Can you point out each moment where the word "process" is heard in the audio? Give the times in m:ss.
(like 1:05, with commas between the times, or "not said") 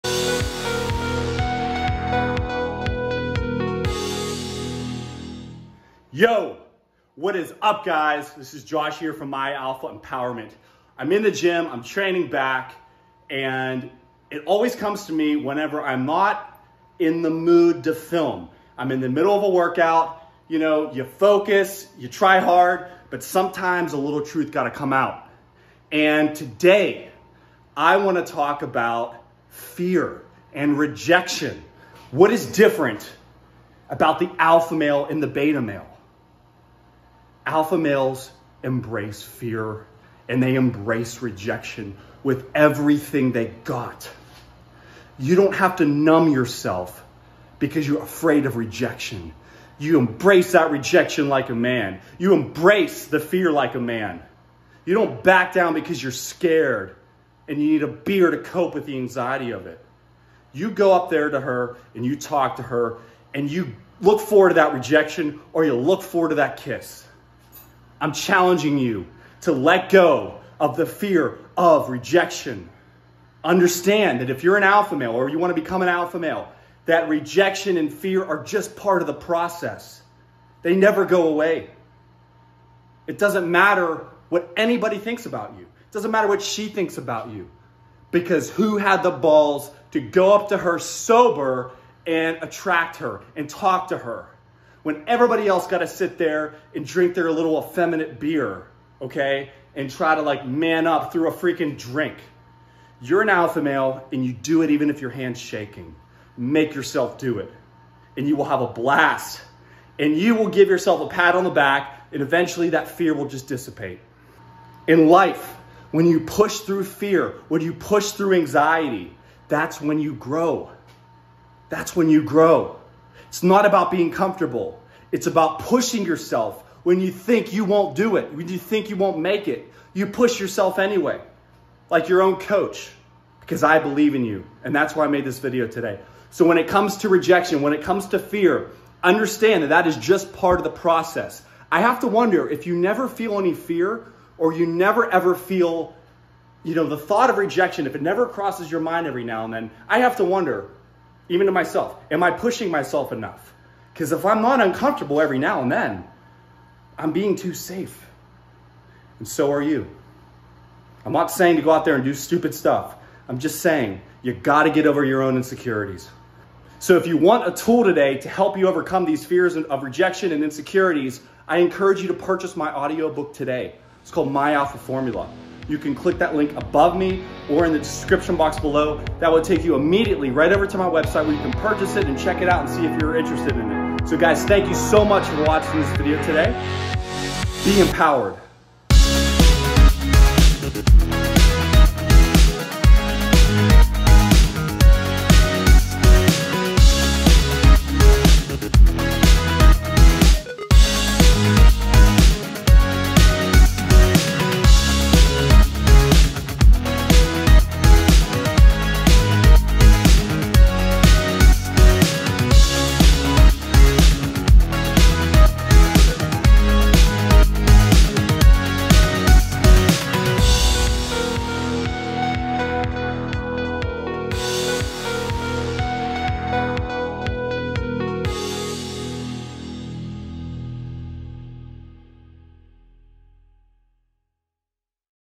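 1:19, 2:20.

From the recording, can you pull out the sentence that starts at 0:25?
And today, I want to talk about fear and rejection.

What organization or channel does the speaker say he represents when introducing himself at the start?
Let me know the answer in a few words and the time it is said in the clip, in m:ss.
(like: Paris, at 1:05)
My Alpha Empowerment, at 0:09.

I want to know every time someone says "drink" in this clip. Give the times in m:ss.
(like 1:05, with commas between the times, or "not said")
1:36, 1:41.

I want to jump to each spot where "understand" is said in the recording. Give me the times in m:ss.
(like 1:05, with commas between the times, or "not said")
1:13, 2:19.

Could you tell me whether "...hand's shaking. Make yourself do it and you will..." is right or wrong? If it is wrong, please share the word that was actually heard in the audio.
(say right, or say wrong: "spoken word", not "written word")
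right.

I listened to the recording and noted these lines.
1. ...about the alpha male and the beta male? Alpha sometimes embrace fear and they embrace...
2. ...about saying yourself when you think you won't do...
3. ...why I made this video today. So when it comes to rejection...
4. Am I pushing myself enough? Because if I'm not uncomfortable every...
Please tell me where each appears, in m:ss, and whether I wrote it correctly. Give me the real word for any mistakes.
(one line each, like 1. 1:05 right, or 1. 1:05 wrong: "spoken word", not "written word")
1. 0:33 wrong: "males", not "sometimes"
2. 2:05 wrong: "pushing", not "saying"
3. 2:14 right
4. 2:32 right.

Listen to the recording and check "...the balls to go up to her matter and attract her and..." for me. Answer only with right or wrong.
wrong.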